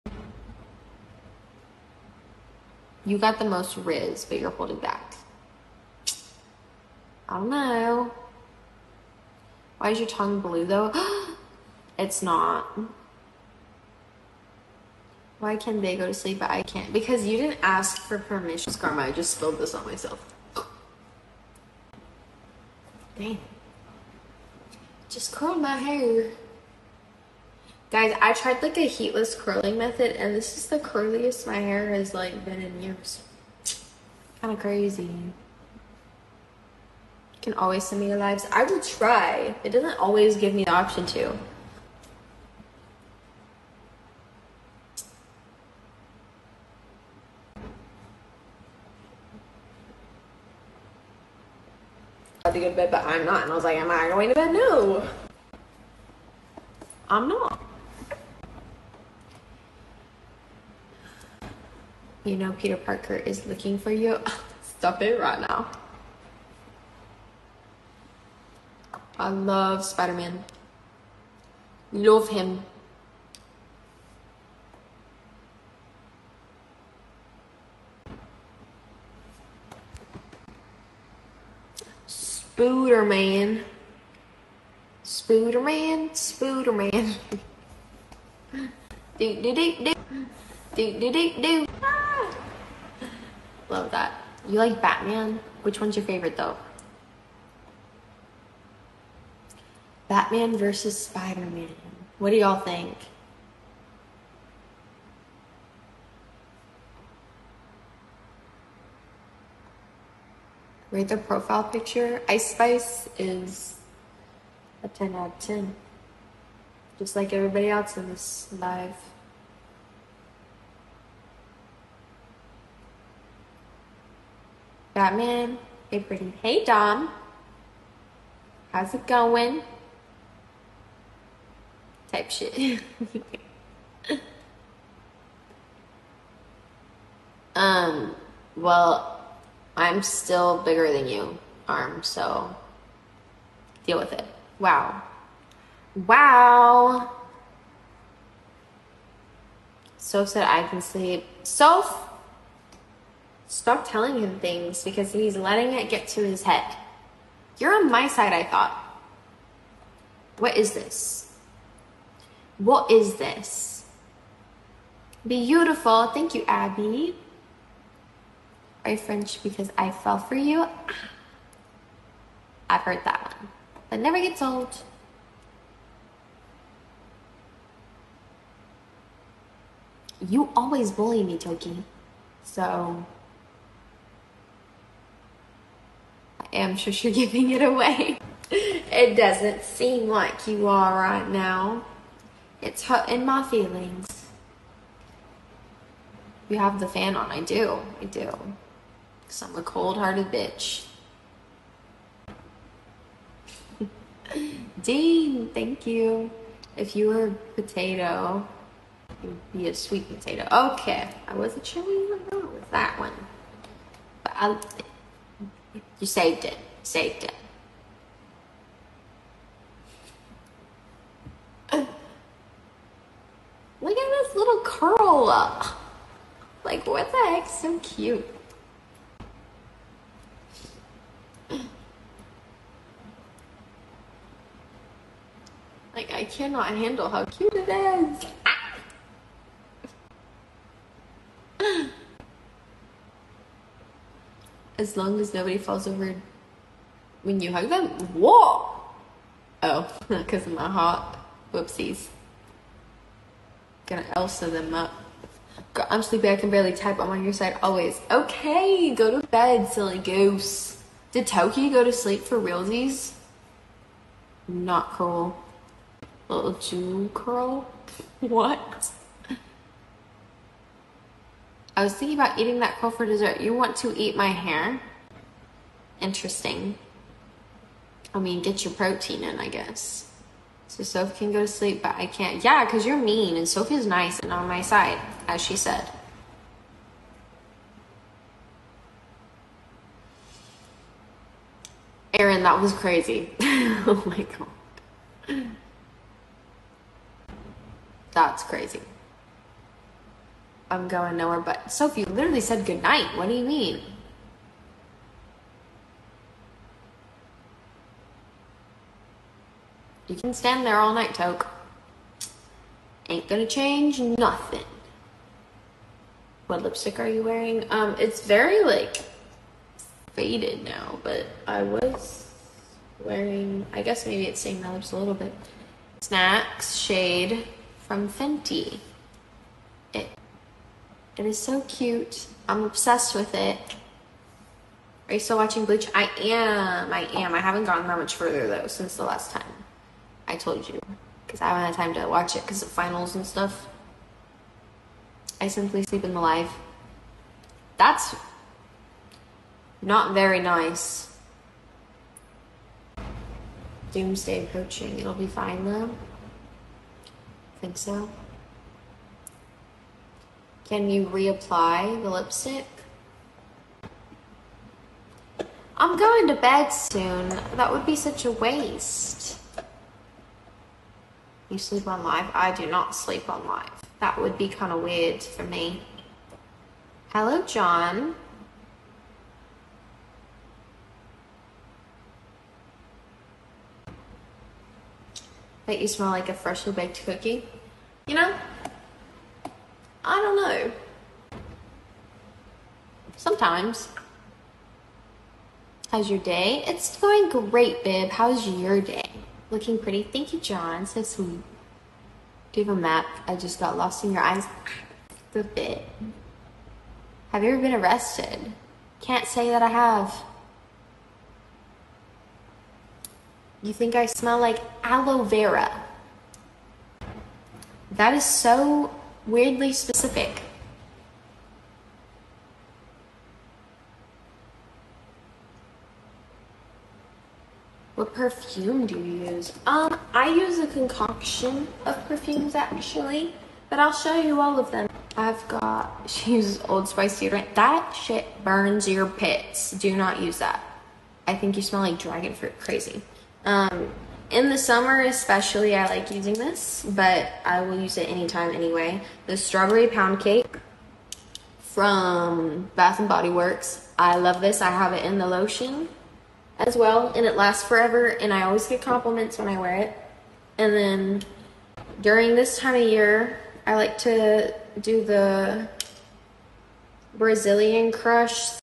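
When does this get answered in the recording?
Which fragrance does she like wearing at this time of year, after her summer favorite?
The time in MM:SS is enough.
07:47.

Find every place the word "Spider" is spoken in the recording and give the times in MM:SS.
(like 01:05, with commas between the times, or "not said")
01:09, 01:41.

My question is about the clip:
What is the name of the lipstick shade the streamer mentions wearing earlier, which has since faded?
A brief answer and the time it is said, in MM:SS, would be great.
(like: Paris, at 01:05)
Snacks, at 05:26.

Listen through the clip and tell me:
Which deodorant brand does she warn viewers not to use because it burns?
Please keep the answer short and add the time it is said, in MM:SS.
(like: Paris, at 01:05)
Old Spice, at 07:16.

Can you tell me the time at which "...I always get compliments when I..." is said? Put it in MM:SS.
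07:38.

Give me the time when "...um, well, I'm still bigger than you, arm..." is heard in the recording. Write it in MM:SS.
02:17.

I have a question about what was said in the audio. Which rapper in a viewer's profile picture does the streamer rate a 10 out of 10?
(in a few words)
Ice Spice.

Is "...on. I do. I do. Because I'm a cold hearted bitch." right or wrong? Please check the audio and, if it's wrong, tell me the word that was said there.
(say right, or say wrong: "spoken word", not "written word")
right.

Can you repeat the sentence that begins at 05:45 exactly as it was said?
I simply sleep in the live.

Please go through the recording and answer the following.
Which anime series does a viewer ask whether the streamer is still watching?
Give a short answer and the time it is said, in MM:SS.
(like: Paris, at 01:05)
Bleach, at 05:35.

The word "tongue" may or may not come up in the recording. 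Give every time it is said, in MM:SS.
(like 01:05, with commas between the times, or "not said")
00:10.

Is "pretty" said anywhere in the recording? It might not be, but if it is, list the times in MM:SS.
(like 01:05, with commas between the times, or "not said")
02:05, 06:39.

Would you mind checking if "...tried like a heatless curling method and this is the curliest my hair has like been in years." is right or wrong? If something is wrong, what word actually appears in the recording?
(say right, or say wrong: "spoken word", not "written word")
right.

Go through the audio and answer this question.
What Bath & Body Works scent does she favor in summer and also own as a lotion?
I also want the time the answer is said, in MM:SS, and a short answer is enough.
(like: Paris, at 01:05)
Strawberry Pound Cake, at 07:29.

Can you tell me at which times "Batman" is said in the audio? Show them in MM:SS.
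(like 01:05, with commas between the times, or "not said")
01:34, 01:40, 02:05.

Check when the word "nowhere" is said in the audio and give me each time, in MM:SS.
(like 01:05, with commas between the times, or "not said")
05:01.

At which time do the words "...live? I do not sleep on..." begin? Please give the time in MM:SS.
06:12.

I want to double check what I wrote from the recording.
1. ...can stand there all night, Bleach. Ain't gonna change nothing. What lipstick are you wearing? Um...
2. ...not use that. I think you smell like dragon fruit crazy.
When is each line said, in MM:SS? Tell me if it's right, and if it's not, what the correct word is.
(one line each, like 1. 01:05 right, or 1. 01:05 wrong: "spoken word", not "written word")
1. 05:10 wrong: "Toke", not "Bleach"
2. 07:19 right.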